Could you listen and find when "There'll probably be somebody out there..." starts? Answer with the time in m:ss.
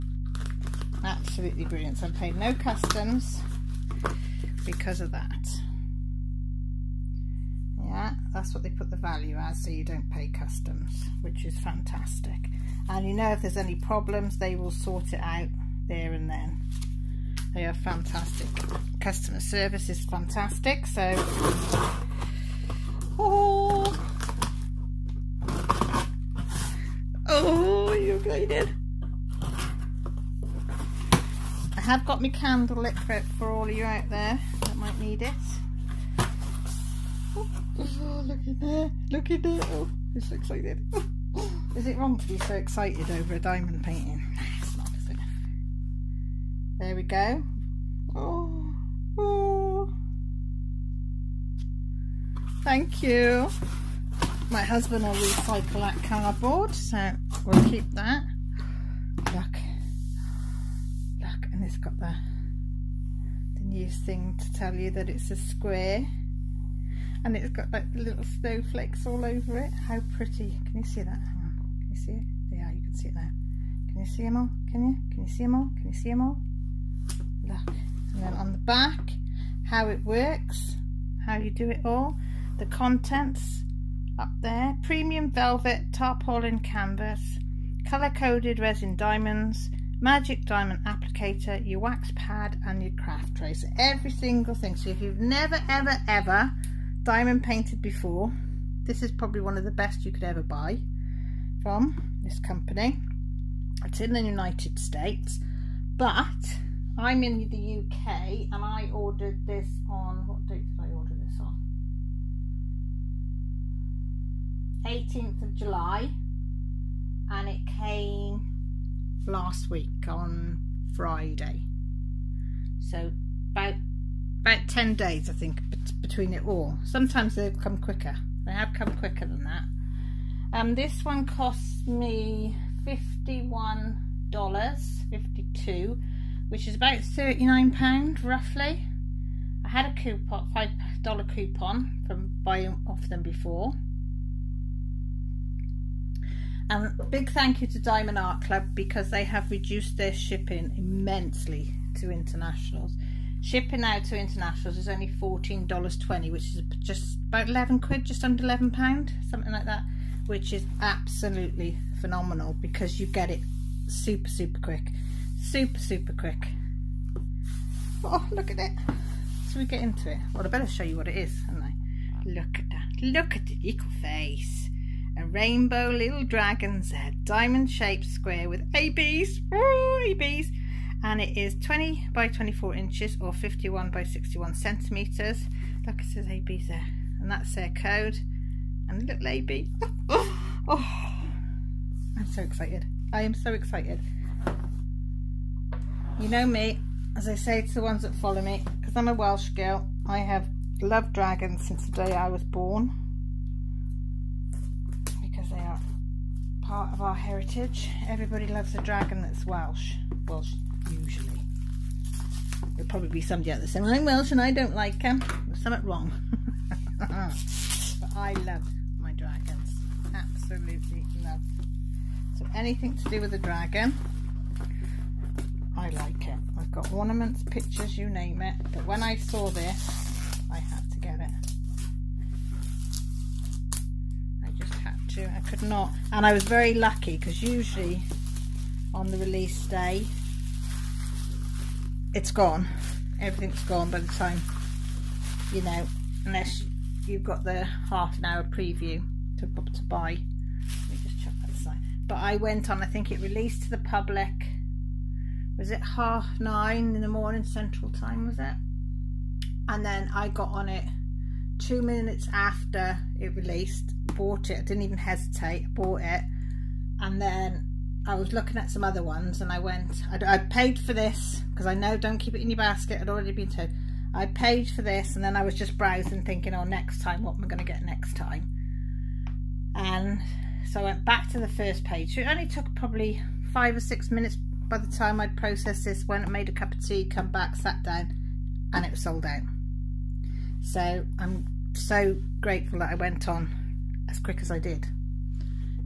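3:32.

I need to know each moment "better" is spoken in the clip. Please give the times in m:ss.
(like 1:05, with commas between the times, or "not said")
2:50.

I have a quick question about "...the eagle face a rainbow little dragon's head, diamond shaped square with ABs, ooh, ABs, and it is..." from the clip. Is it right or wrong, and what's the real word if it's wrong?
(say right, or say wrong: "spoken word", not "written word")
right.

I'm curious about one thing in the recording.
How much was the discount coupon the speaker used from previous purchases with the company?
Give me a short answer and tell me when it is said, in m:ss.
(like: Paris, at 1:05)
$5, at 2:20.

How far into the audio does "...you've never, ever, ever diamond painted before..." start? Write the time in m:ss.
1:35.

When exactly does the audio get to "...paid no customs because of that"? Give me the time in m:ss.
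0:02.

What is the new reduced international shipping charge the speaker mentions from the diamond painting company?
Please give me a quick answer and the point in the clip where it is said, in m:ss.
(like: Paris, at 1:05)
$14.20, at 2:35.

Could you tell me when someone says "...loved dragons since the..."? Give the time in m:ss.
3:20.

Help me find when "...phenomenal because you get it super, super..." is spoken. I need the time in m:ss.
2:41.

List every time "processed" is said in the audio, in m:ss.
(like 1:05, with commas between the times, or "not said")
4:45.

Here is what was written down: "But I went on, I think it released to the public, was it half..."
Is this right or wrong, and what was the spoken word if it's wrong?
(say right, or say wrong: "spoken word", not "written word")
right.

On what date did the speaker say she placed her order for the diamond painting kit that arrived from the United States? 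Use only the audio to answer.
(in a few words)
18th of July.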